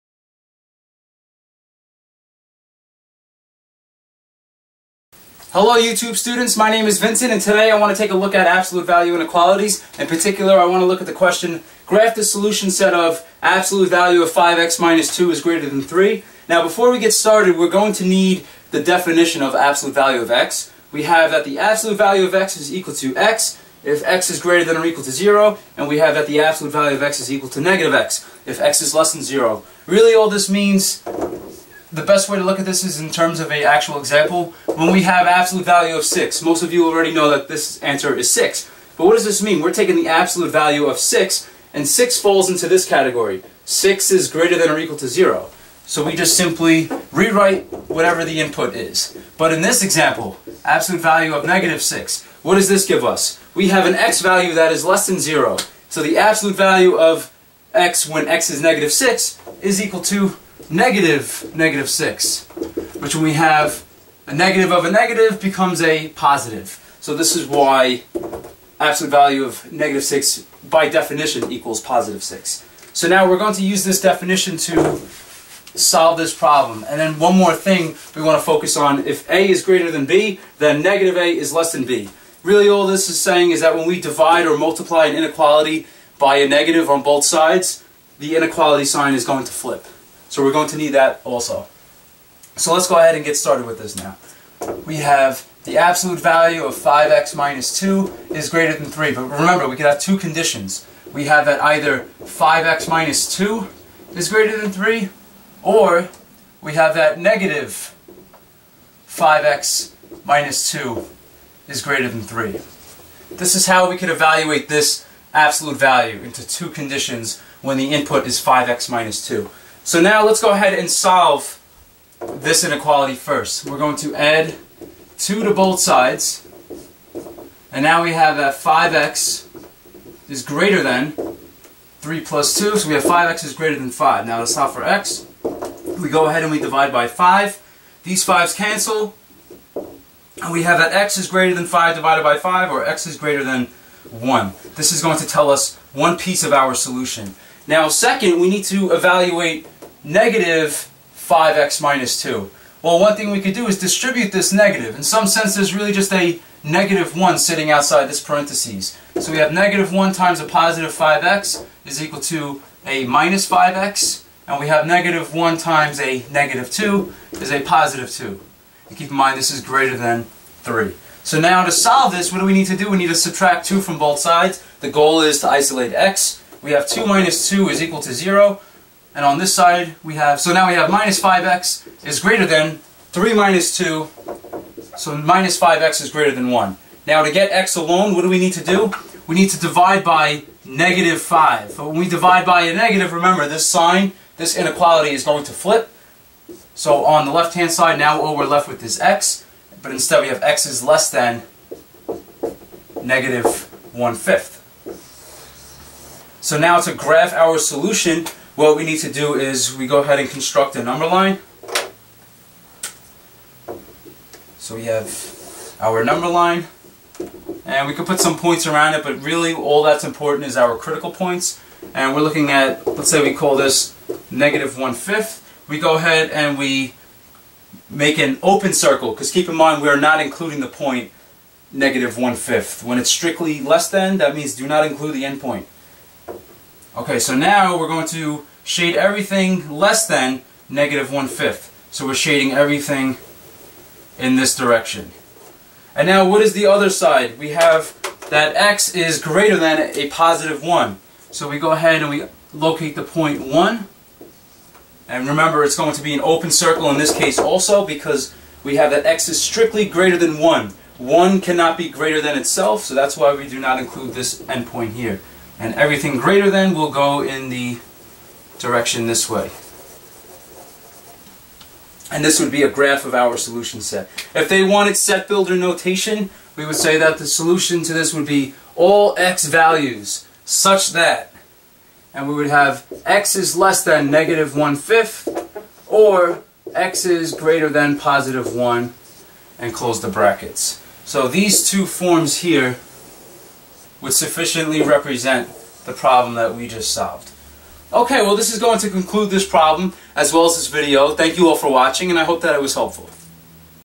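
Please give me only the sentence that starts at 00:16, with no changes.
Now before we get started, we're going to need the definition of absolute value of x.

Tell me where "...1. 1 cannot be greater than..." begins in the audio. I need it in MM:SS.
04:20.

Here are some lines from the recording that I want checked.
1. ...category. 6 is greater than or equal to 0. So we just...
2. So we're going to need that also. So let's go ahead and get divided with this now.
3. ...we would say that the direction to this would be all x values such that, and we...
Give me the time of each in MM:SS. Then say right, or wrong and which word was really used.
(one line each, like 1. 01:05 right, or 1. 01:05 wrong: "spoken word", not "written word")
1. 00:42 right
2. 01:30 wrong: "started", not "divided"
3. 04:36 wrong: "solution", not "direction".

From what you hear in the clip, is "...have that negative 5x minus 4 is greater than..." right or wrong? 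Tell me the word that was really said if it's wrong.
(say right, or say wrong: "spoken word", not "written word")
wrong: "2", not "4".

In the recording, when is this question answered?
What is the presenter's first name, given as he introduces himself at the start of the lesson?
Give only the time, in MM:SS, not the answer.
00:06.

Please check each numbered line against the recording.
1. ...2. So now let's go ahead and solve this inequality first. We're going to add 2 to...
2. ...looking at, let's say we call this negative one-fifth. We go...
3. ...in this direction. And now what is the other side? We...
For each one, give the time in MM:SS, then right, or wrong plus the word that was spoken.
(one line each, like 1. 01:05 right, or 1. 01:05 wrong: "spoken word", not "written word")
1. 01:59 right
2. 03:42 right
3. 04:04 right.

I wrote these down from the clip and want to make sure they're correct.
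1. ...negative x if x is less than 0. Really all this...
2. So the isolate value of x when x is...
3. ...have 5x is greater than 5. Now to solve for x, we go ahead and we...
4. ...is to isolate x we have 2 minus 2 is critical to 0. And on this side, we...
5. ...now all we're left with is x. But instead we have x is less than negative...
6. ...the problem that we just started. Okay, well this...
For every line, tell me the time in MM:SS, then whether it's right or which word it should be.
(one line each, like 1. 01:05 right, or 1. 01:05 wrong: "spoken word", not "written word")
1. 00:27 right
2. 00:55 wrong: "absolute", not "isolate"
3. 02:12 right
4. 02:55 wrong: "equal", not "critical"
5. 03:17 right
6. 04:55 wrong: "solved", not "started".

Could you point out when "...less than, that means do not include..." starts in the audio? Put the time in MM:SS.
03:53.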